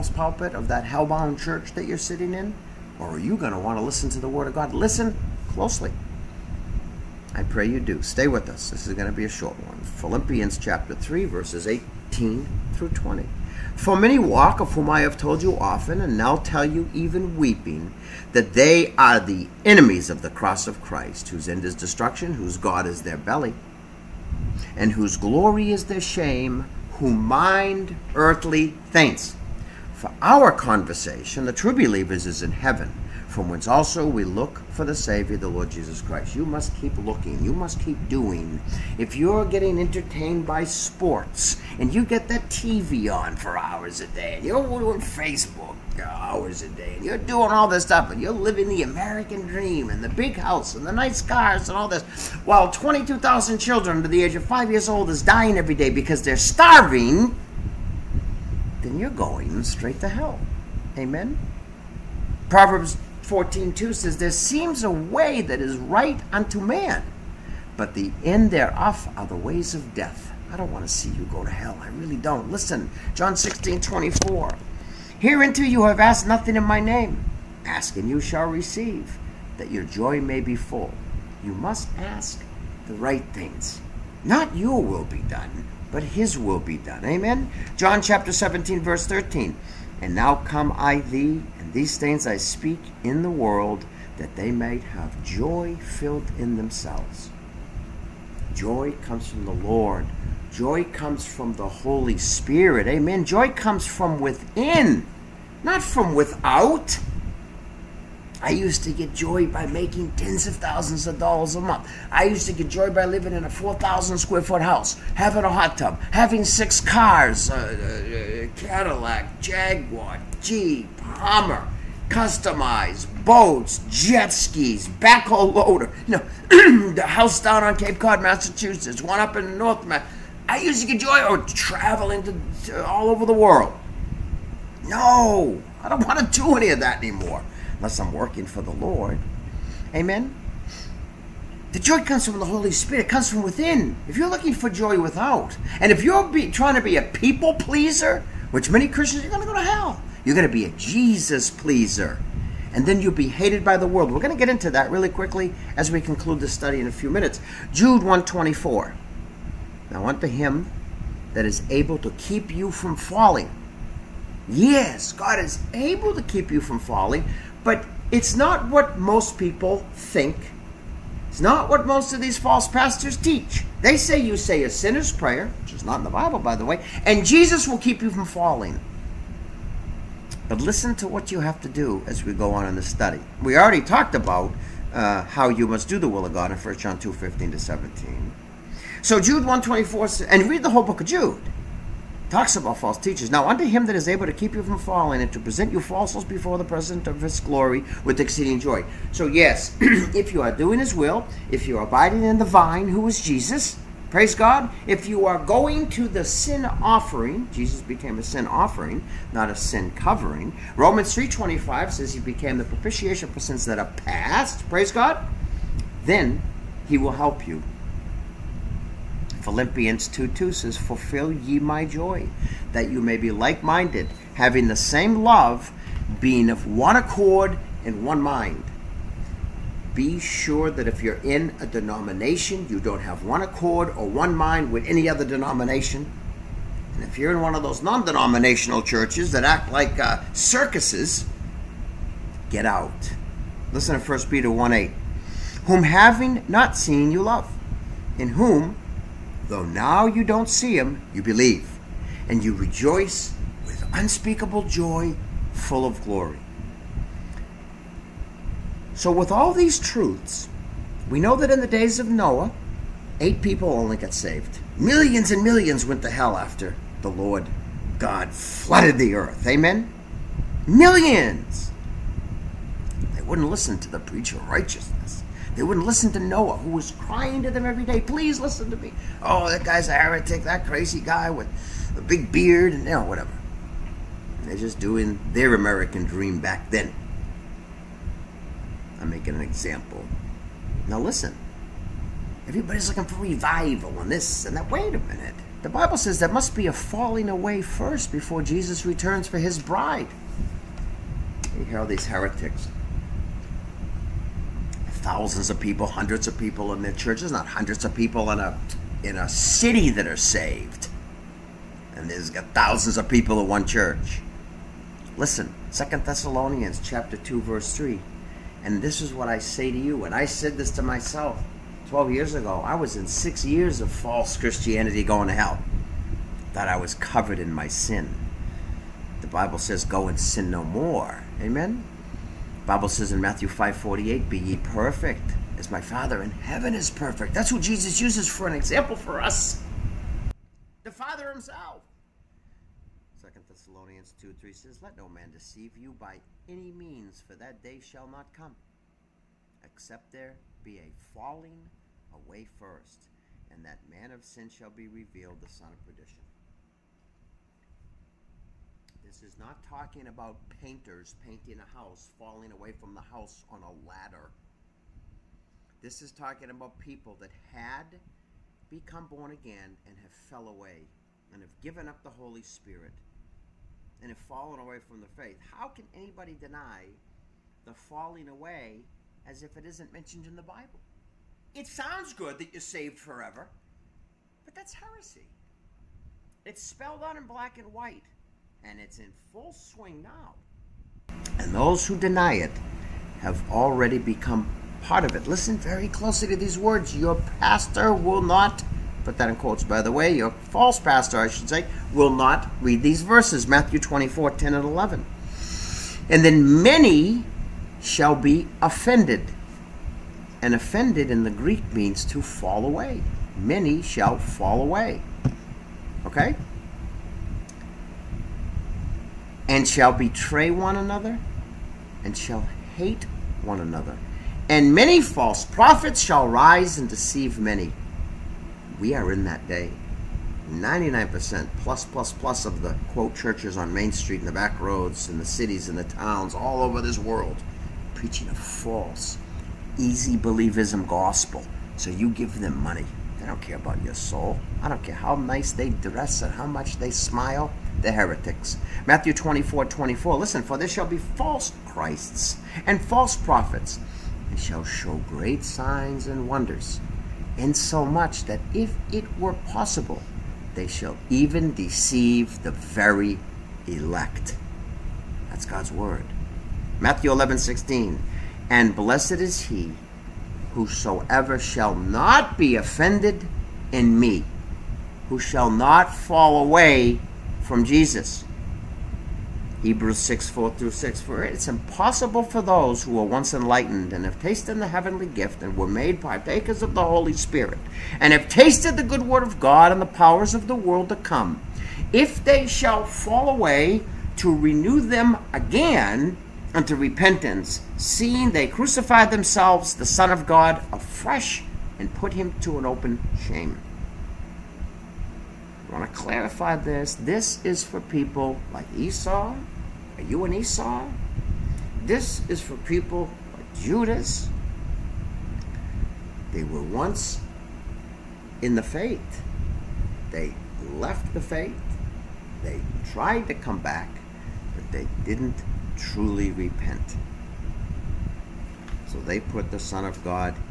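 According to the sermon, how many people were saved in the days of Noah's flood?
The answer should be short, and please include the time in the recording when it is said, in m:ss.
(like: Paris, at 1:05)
8, at 4:23.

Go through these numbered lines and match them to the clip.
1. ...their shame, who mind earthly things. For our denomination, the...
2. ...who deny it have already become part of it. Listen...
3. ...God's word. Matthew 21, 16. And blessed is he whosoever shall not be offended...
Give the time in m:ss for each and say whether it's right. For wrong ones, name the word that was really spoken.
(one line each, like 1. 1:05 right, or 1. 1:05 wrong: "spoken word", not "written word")
1. 0:25 wrong: "conversation", not "denomination"
2. 6:31 right
3. 7:45 wrong: "11", not "21".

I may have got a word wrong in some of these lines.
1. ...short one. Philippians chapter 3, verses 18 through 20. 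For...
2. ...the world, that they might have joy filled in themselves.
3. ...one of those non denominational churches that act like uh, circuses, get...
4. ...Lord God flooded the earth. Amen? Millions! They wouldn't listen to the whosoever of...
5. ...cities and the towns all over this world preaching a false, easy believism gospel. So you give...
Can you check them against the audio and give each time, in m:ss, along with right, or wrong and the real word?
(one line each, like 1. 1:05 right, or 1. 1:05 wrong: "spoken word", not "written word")
1. 0:09 right
2. 1:33 right
3. 3:57 right
4. 4:27 wrong: "preacher", not "whosoever"
5. 7:15 right.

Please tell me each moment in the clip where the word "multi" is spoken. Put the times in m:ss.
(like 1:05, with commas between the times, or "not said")
not said.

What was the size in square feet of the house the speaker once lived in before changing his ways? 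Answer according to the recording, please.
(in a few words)
4,000.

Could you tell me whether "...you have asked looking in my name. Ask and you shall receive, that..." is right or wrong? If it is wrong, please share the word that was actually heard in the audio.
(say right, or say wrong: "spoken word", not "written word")
wrong: "nothing", not "looking".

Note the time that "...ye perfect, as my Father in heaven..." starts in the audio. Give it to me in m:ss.
5:34.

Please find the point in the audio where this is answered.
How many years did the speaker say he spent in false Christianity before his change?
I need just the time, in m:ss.
5:23.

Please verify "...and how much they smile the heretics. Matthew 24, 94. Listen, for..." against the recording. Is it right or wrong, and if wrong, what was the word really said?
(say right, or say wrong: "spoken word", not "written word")
wrong: "24", not "94".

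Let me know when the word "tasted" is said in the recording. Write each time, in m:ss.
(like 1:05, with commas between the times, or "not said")
8:04, 8:08.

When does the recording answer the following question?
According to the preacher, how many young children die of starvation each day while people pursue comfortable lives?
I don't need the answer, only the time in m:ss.
0:52.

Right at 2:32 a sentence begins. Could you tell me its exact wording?
And then you'll be hated by the world.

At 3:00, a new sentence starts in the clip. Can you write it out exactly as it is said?
But listen to what you have to do as we go on in the study.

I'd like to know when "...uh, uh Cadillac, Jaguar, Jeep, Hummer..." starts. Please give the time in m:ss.
1:57.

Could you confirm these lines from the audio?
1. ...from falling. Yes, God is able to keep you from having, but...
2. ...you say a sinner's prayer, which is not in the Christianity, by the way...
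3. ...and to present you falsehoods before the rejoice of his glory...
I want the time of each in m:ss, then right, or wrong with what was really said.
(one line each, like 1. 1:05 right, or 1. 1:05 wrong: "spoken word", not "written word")
1. 2:42 wrong: "falling", not "having"
2. 2:54 wrong: "Bible", not "Christianity"
3. 3:15 wrong: "presence", not "rejoice".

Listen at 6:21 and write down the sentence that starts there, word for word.
It sounds good that you're saved forever, but that's heresy.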